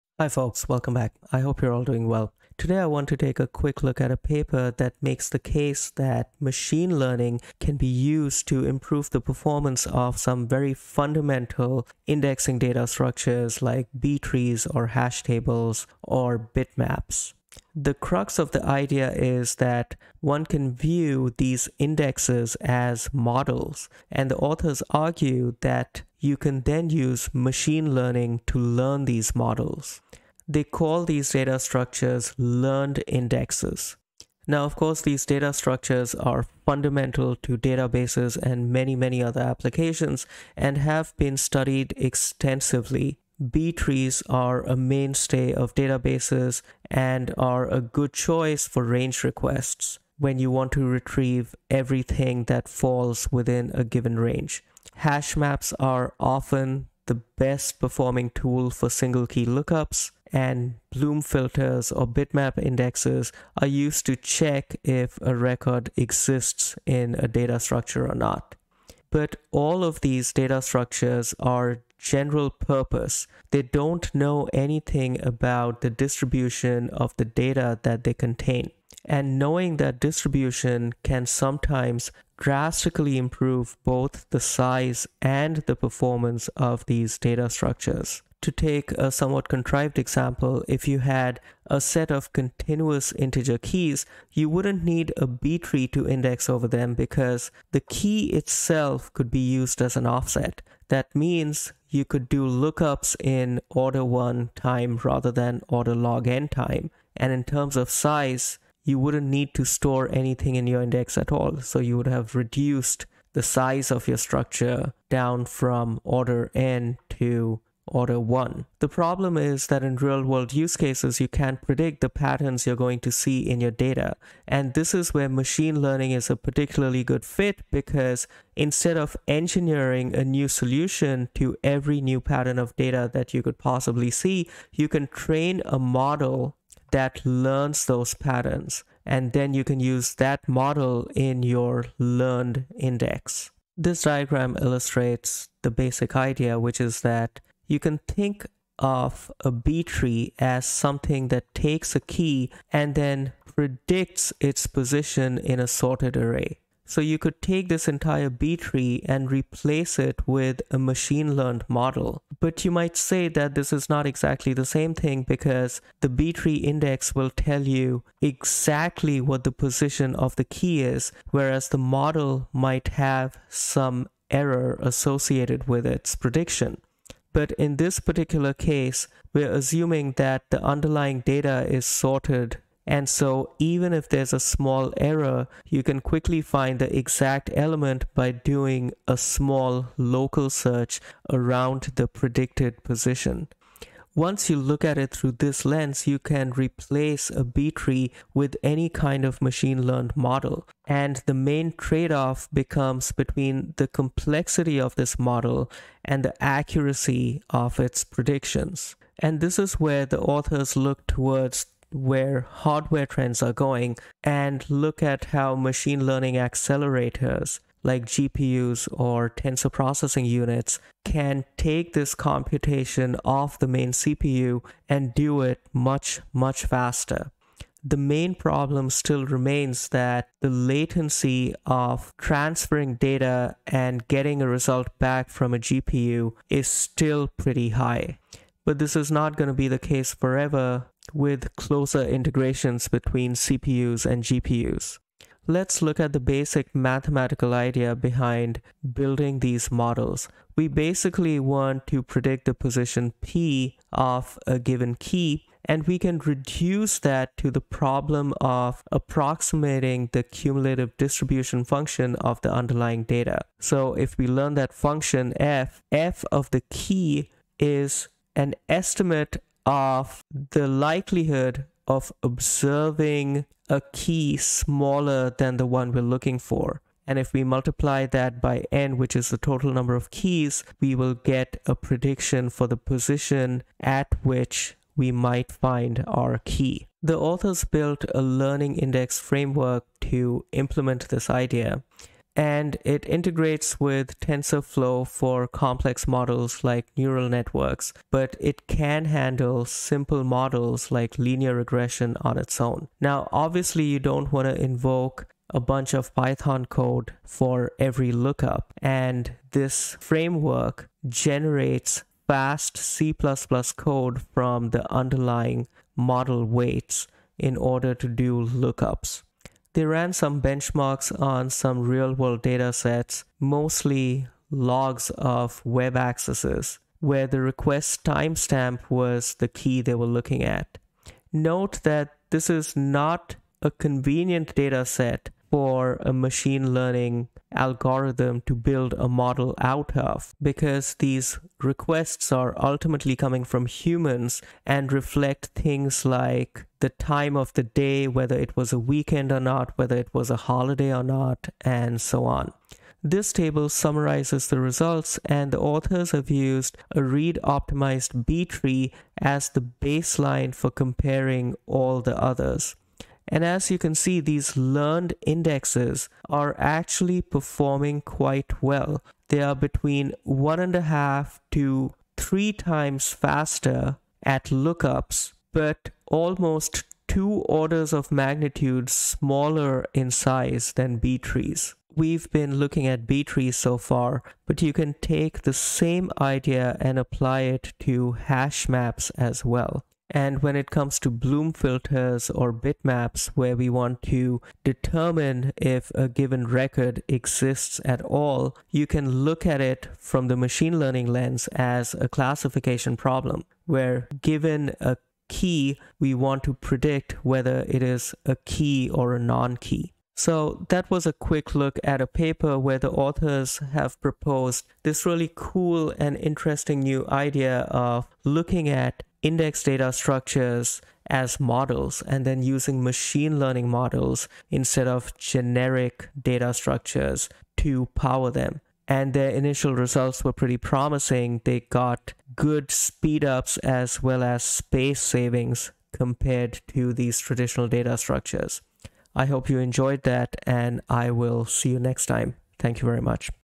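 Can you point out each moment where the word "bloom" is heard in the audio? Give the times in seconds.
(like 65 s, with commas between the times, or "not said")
60 s, 391 s.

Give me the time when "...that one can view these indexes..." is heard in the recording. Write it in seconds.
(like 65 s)
19 s.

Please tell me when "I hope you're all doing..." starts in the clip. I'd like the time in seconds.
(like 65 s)
1 s.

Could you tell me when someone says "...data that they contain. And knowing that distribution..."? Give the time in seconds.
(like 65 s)
77 s.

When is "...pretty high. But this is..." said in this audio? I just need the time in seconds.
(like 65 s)
237 s.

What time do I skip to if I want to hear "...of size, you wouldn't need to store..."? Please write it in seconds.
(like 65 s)
107 s.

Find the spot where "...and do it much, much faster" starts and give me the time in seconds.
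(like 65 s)
224 s.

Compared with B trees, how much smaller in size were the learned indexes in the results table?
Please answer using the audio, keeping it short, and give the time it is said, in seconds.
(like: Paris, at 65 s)
almost 2 orders of magnitude, at 376 s.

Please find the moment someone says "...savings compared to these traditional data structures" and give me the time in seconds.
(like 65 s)
435 s.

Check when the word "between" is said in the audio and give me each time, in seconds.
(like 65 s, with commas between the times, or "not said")
203 s, 242 s, 369 s.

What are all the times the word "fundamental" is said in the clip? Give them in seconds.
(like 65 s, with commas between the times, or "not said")
10 s, 36 s.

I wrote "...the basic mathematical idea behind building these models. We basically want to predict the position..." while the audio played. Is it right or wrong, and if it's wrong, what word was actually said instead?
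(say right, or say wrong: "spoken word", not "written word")
right.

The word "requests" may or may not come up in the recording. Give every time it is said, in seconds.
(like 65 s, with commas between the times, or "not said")
49 s, 327 s, 341 s.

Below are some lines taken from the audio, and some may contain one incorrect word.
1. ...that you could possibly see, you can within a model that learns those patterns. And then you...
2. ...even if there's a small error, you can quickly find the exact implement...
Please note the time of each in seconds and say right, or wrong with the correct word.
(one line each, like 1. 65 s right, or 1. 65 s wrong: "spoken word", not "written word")
1. 133 s wrong: "train", not "within"
2. 183 s wrong: "element", not "implement".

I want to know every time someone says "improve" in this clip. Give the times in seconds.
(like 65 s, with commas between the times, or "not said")
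8 s, 83 s.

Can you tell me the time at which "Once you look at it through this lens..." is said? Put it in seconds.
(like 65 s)
194 s.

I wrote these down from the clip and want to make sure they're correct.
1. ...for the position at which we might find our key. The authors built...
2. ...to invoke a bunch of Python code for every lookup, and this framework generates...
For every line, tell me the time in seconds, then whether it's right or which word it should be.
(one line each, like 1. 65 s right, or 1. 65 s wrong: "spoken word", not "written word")
1. 282 s right
2. 304 s right.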